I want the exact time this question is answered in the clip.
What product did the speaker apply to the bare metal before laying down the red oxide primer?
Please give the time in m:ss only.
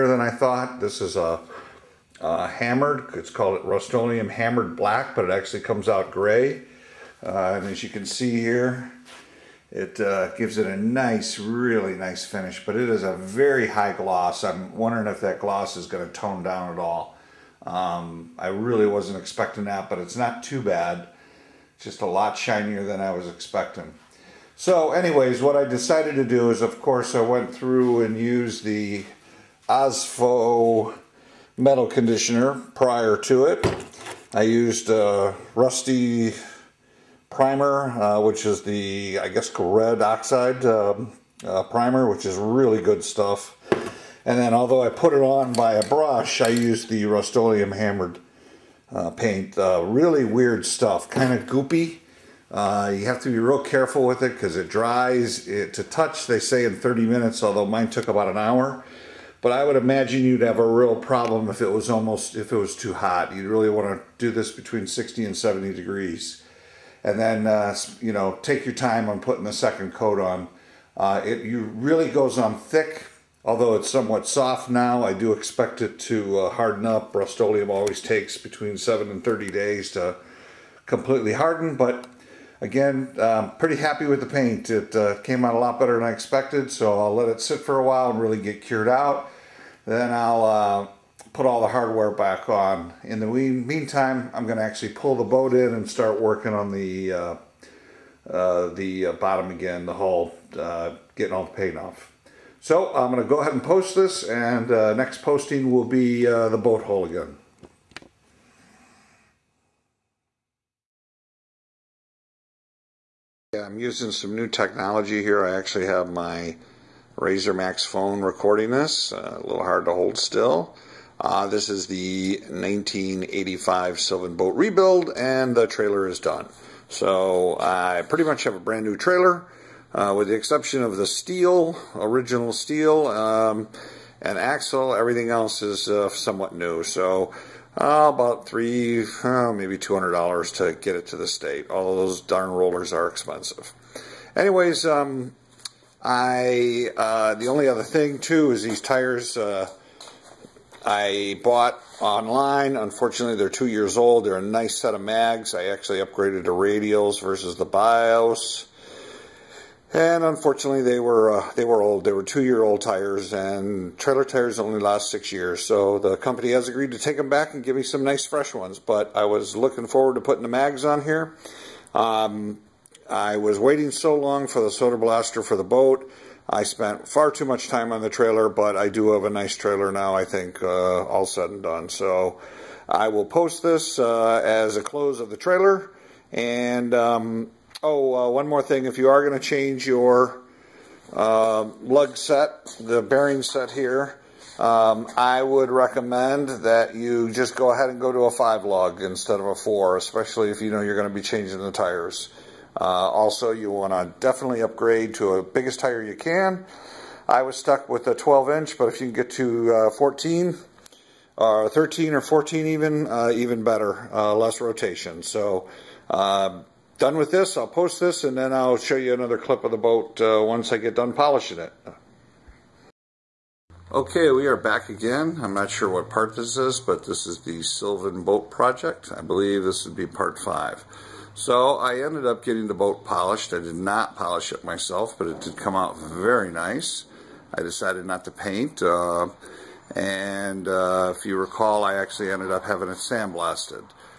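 0:29.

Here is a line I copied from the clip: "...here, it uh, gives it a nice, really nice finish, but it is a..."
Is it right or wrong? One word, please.
right.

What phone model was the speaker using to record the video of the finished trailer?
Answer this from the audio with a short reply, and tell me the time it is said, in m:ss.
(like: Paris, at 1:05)
RAZR Maxx, at 1:57.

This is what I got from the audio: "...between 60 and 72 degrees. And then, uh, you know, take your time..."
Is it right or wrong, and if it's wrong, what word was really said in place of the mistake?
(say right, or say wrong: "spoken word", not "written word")
wrong: "70", not "72".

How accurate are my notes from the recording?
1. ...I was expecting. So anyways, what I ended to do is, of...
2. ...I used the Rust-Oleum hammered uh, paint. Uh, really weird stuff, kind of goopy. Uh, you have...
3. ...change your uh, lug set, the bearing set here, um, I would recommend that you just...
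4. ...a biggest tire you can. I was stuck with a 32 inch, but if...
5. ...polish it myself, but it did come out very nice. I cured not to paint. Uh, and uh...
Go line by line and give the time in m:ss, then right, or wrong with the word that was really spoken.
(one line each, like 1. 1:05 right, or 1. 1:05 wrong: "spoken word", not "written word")
1. 0:22 wrong: "decided", not "ended"
2. 0:46 right
3. 3:09 right
4. 3:25 wrong: "12", not "32"
5. 3:54 wrong: "decided", not "cured".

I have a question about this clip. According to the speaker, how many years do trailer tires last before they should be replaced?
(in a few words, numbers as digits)
6 years.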